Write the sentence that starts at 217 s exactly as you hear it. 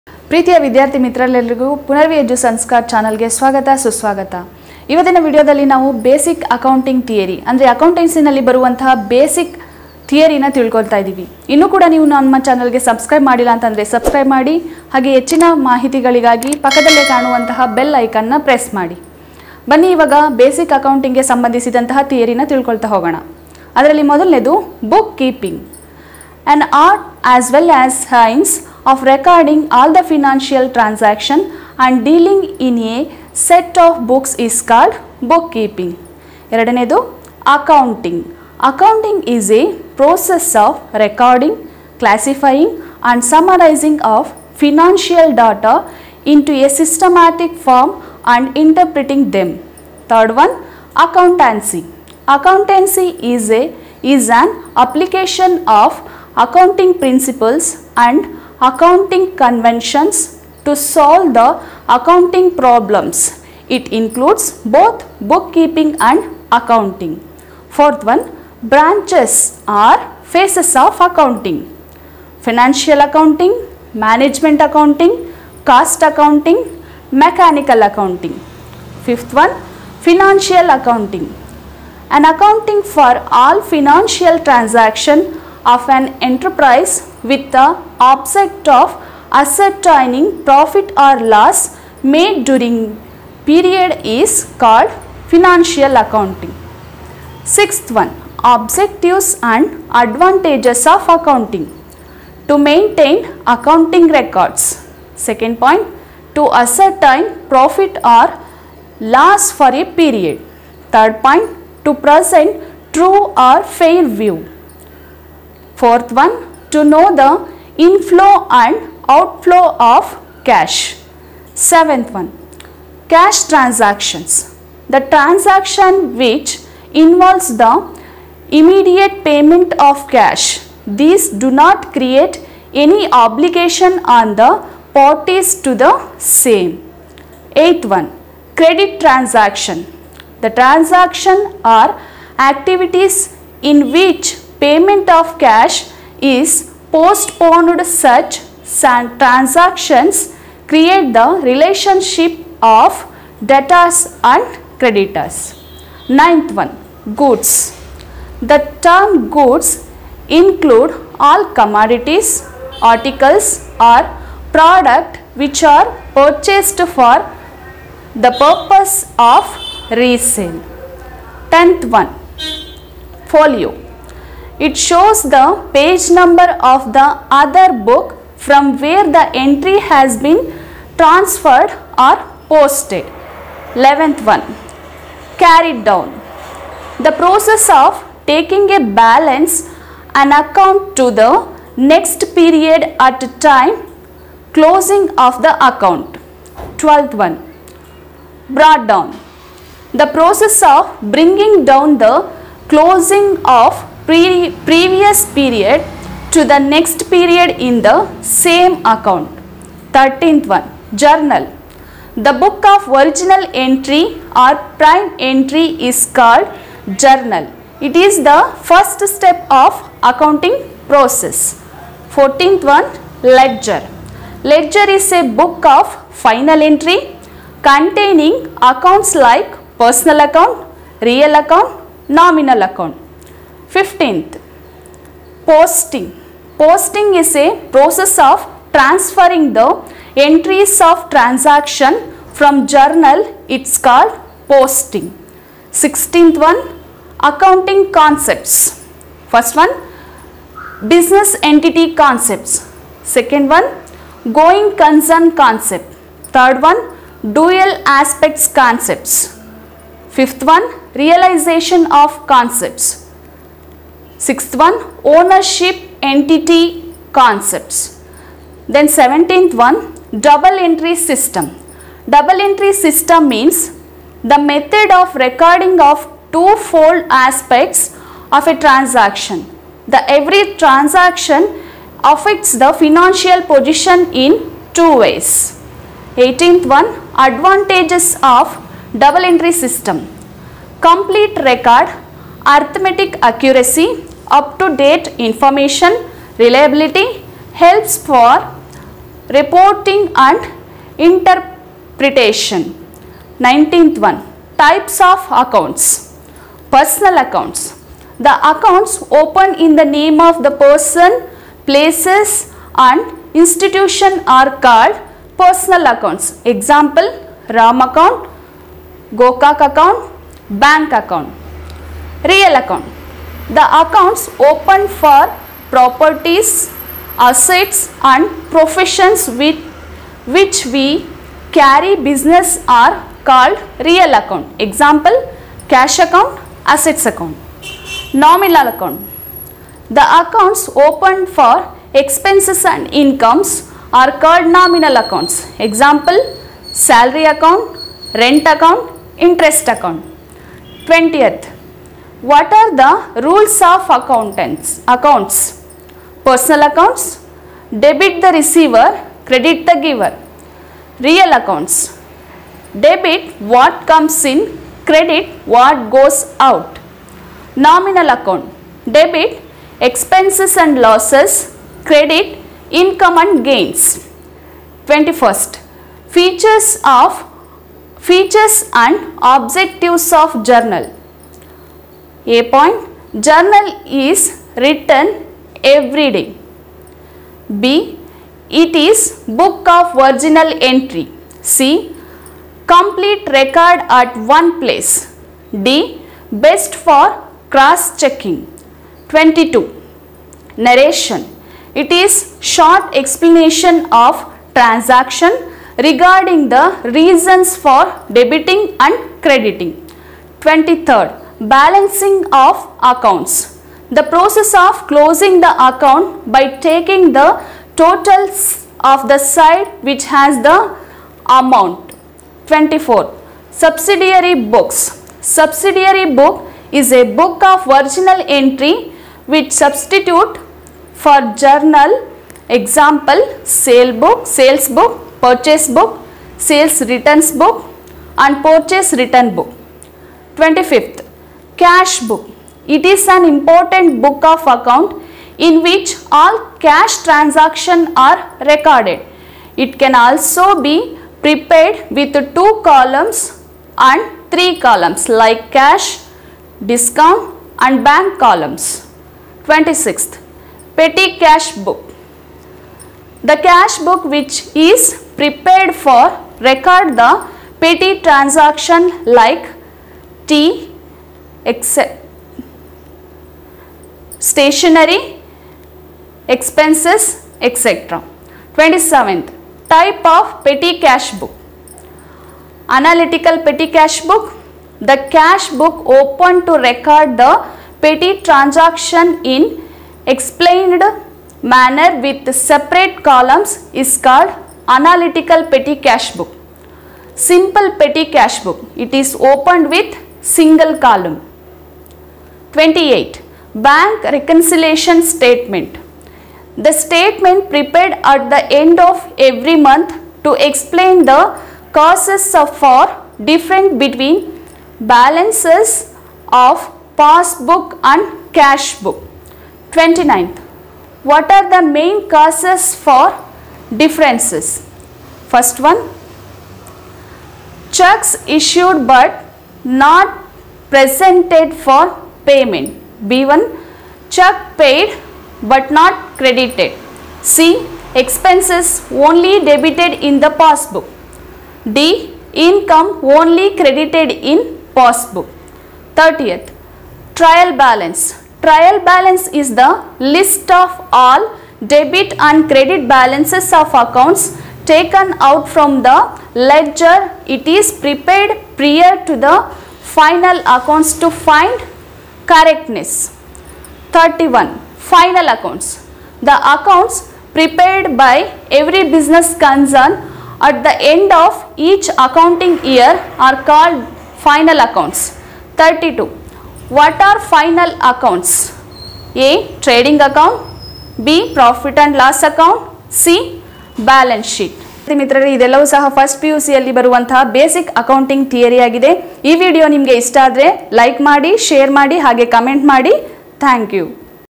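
It is the first step of accounting process.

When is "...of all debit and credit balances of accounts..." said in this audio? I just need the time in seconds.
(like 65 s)
550 s.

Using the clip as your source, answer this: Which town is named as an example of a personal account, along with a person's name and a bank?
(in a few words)
Gokak.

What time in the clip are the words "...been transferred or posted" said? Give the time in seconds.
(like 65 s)
180 s.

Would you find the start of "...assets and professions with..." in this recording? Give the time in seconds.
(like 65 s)
327 s.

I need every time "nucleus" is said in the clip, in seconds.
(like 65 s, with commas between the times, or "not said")
not said.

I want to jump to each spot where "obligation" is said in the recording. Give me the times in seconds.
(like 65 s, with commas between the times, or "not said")
133 s.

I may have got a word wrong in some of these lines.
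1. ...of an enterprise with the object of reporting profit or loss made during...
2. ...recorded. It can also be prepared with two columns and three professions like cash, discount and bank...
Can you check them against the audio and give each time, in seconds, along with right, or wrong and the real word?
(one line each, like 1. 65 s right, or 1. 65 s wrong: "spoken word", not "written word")
1. 85 s wrong: "ascertaining", not "reporting"
2. 448 s wrong: "columns", not "professions".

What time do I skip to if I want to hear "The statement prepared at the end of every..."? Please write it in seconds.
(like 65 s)
506 s.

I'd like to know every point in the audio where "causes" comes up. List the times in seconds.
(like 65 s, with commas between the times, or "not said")
511 s, 522 s.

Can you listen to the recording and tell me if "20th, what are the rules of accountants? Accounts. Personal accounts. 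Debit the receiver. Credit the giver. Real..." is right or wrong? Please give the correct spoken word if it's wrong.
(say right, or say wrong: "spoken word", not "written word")
right.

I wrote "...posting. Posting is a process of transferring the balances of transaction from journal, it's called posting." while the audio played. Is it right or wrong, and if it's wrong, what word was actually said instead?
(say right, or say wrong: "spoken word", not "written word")
wrong: "entries", not "balances".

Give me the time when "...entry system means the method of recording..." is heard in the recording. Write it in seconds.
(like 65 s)
272 s.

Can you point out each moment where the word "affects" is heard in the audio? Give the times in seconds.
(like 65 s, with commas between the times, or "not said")
282 s.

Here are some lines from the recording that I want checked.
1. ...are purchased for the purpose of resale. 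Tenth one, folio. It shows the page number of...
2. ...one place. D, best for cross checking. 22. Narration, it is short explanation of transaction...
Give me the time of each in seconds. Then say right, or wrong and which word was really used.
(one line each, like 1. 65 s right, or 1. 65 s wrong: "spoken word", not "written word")
1. 165 s right
2. 394 s right.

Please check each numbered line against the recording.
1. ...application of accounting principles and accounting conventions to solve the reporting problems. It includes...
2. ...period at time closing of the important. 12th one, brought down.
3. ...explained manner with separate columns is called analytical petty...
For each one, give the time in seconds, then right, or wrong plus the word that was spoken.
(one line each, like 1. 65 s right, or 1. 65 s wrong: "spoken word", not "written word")
1. 54 s wrong: "accounting", not "reporting"
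2. 192 s wrong: "account", not "important"
3. 490 s right.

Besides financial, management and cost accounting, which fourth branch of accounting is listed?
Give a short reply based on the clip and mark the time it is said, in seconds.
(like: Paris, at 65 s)
Mechanical accounting, at 77 s.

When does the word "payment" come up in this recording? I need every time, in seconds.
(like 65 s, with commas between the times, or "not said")
129 s, 144 s, 532 s.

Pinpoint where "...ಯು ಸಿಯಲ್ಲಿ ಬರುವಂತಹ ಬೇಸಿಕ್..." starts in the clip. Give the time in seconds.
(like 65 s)
586 s.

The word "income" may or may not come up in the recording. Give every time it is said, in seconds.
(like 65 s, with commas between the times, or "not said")
343 s, 372 s, 542 s.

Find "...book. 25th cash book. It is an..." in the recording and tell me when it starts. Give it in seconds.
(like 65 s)
439 s.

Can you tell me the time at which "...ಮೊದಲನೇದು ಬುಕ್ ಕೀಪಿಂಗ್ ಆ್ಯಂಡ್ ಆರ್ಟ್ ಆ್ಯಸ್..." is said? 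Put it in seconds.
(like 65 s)
24 s.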